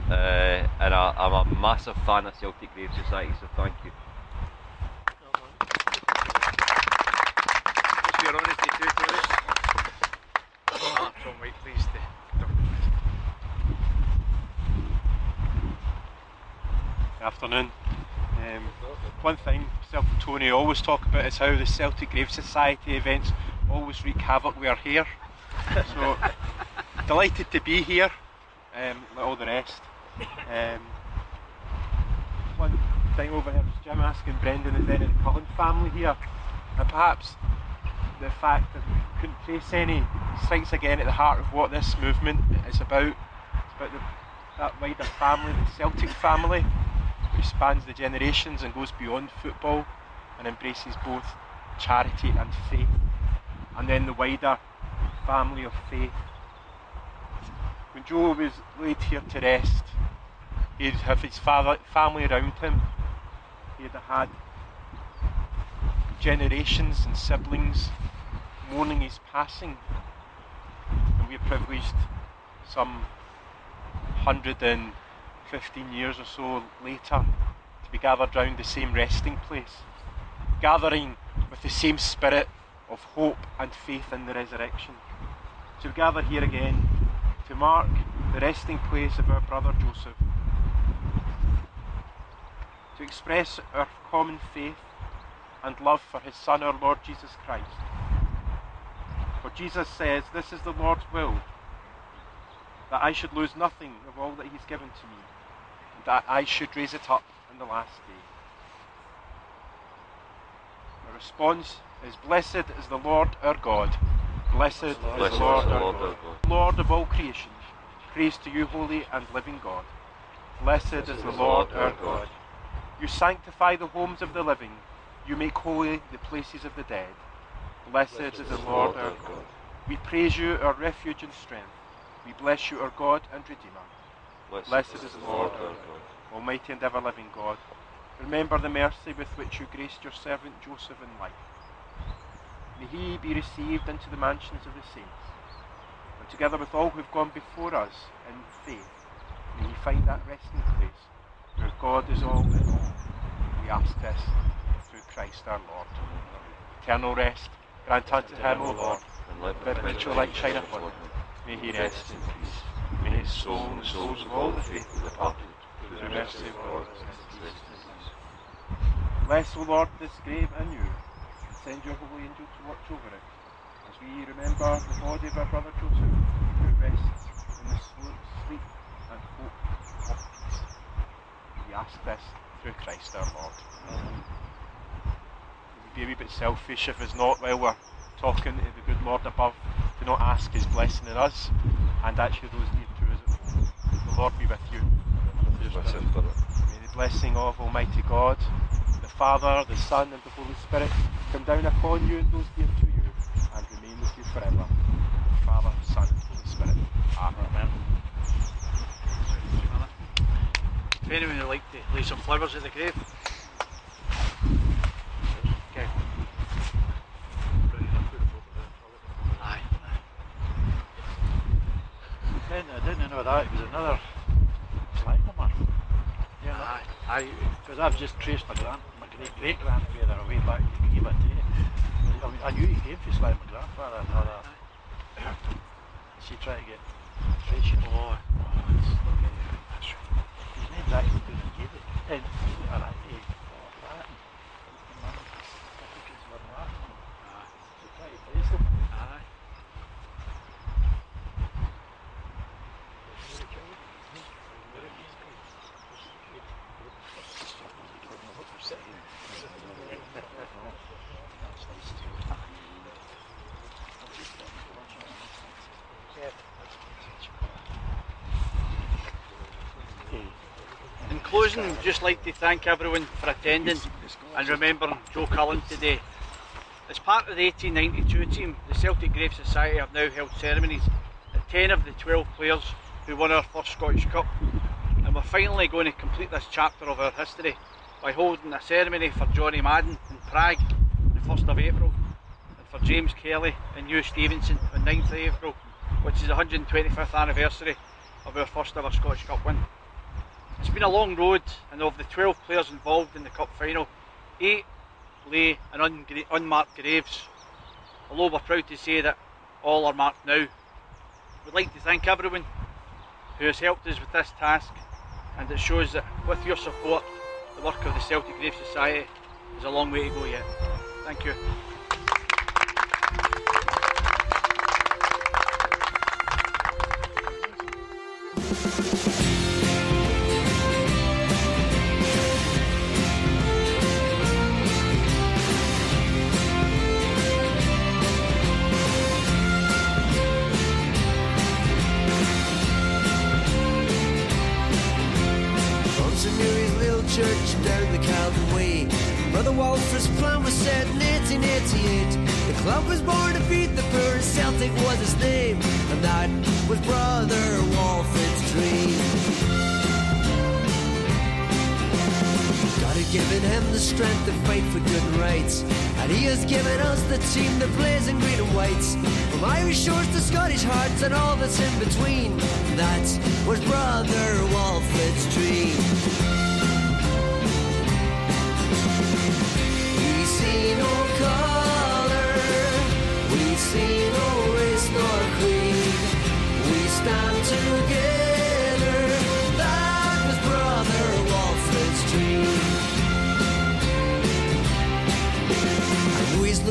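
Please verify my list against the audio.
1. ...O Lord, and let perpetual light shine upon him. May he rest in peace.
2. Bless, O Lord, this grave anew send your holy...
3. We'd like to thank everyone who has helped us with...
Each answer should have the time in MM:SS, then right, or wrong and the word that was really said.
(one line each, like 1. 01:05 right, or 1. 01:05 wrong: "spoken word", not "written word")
1. 02:38 right
2. 02:49 right
3. 05:11 right.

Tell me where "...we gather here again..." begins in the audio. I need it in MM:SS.
01:25.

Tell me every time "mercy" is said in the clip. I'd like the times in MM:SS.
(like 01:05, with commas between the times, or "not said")
02:18, 02:46.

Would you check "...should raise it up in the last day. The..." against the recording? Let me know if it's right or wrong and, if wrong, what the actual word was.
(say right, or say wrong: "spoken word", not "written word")
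right.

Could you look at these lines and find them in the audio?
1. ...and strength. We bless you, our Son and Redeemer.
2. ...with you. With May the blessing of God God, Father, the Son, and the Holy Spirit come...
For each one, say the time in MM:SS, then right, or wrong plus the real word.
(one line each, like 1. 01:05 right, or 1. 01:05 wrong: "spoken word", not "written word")
1. 02:11 wrong: "God", not "Son"
2. 03:14 wrong: "Almighty", not "God".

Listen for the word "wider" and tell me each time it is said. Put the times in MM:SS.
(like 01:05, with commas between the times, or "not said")
00:44, 00:54.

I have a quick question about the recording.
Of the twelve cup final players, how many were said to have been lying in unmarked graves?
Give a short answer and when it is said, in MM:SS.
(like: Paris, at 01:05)
8, at 05:04.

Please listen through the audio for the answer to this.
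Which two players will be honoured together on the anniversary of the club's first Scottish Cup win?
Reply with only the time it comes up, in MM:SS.
04:52.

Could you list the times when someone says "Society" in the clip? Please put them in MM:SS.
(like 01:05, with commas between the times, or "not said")
00:03, 00:22, 04:39, 05:18.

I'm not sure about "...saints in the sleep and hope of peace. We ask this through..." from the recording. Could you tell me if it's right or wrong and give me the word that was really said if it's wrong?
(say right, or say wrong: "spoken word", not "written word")
wrong: "rests", not "saints".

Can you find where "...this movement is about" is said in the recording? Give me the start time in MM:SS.
00:41.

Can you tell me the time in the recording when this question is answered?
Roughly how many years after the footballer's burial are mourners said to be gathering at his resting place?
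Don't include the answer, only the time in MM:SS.
01:14.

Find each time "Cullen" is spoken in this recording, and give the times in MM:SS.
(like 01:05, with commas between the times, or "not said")
00:35, 04:35.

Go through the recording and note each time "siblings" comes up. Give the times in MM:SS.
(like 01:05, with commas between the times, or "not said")
01:07.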